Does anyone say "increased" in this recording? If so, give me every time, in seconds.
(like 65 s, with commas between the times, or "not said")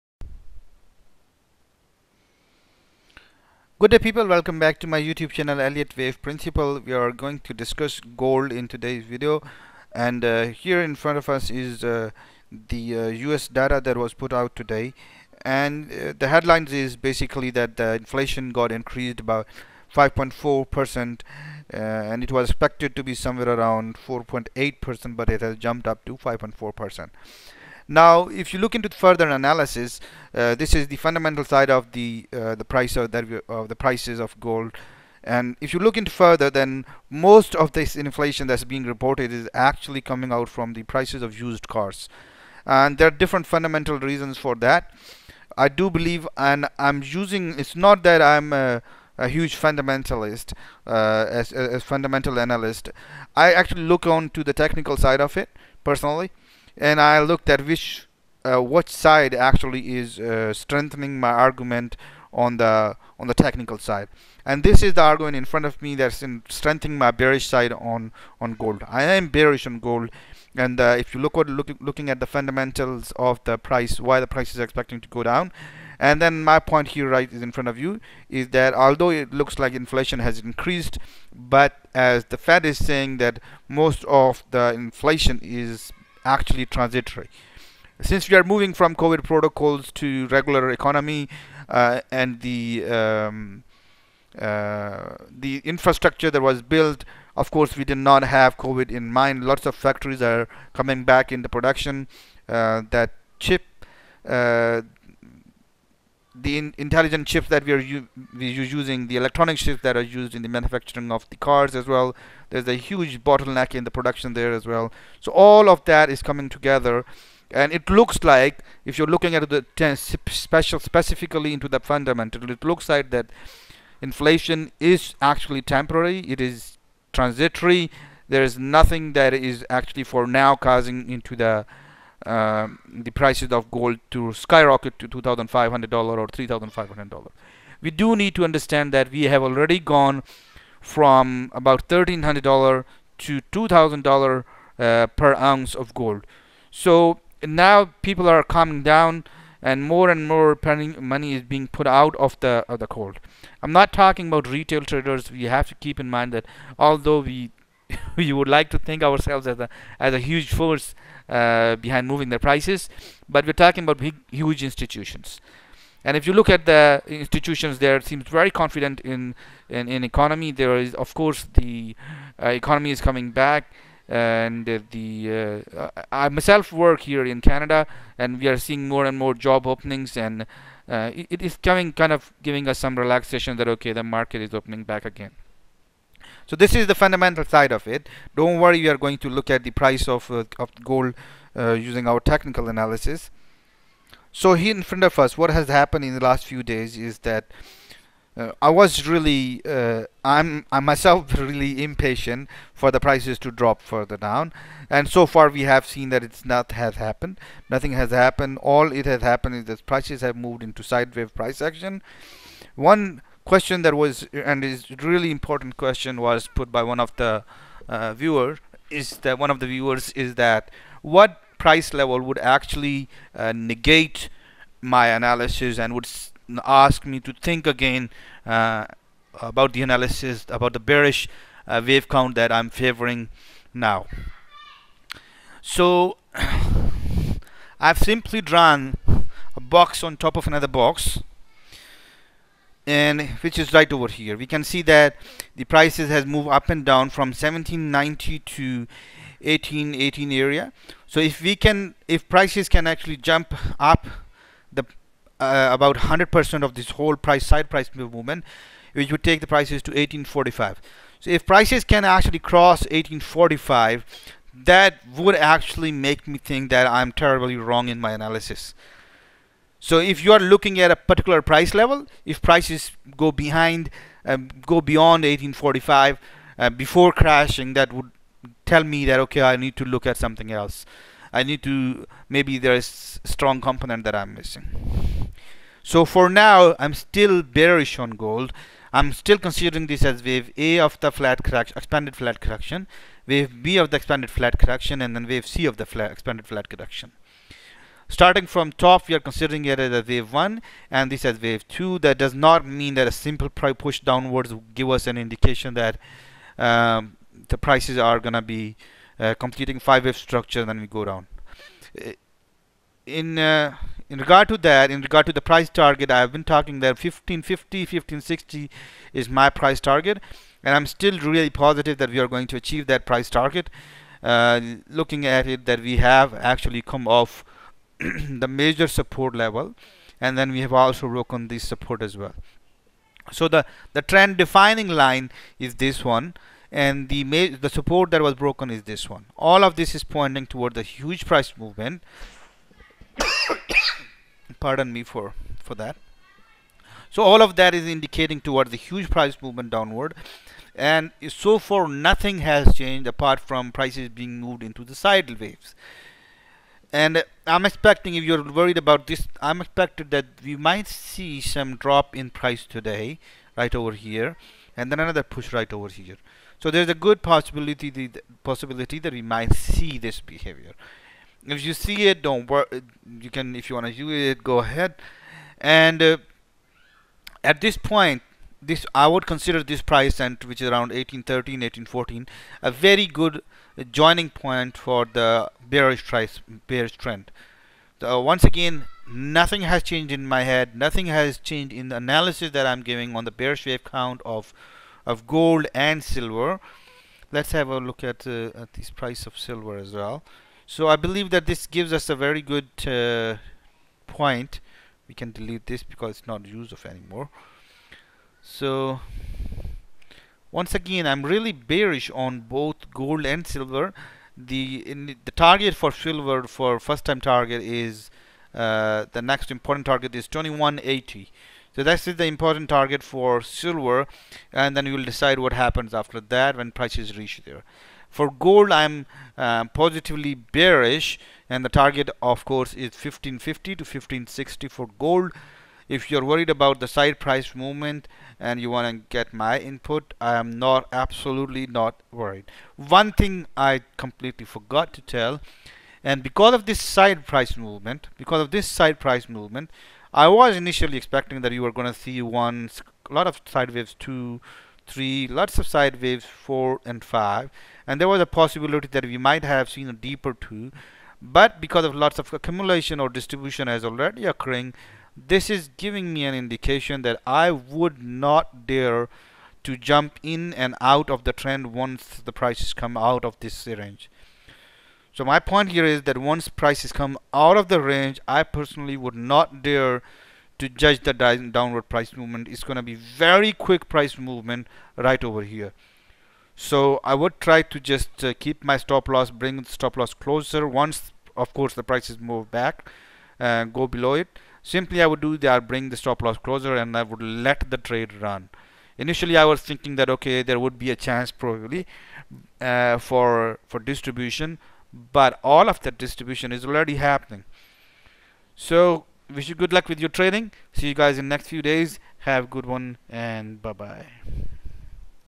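18 s, 80 s.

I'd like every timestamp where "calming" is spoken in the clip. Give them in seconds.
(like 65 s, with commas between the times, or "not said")
148 s.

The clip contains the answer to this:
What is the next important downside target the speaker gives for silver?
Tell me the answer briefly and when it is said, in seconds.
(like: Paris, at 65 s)
2180, at 420 s.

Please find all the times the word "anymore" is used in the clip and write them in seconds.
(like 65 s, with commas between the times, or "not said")
406 s.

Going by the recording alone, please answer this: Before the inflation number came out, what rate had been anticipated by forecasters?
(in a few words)
4.8%.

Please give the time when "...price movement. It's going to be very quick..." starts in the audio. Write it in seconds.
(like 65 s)
481 s.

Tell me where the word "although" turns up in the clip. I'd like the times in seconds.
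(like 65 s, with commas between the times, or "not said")
78 s, 156 s.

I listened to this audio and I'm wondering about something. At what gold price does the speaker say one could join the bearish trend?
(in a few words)
1813-1814.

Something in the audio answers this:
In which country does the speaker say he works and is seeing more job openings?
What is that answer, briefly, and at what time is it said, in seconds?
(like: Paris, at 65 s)
Canada, at 177 s.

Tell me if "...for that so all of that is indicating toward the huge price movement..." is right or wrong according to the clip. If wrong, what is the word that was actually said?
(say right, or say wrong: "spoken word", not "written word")
right.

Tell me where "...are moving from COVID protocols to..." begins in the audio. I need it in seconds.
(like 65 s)
88 s.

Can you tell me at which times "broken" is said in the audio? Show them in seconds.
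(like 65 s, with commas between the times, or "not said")
331 s, 338 s.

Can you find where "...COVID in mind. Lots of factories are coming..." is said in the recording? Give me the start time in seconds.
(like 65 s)
98 s.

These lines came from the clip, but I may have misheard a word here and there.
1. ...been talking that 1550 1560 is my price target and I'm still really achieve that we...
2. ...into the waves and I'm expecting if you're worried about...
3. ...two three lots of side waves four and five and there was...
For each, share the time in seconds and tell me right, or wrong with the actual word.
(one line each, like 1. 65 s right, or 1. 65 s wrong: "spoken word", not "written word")
1. 316 s wrong: "positive", not "achieve"
2. 354 s right
3. 454 s right.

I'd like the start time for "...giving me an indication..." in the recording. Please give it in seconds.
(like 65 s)
465 s.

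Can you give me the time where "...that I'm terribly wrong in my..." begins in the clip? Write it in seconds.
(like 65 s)
266 s.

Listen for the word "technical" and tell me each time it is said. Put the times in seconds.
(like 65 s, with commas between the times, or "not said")
54 s, 63 s, 192 s.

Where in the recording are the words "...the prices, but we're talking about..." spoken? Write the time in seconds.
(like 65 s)
162 s.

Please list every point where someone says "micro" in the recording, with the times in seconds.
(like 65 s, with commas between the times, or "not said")
not said.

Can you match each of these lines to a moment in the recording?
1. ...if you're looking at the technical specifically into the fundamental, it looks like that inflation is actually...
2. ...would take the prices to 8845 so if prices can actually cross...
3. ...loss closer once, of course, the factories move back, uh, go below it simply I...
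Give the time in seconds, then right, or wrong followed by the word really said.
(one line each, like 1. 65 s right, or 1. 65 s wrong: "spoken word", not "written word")
1. 118 s wrong: "special", not "technical"
2. 259 s wrong: "1845", not "8845"
3. 489 s wrong: "prices", not "factories".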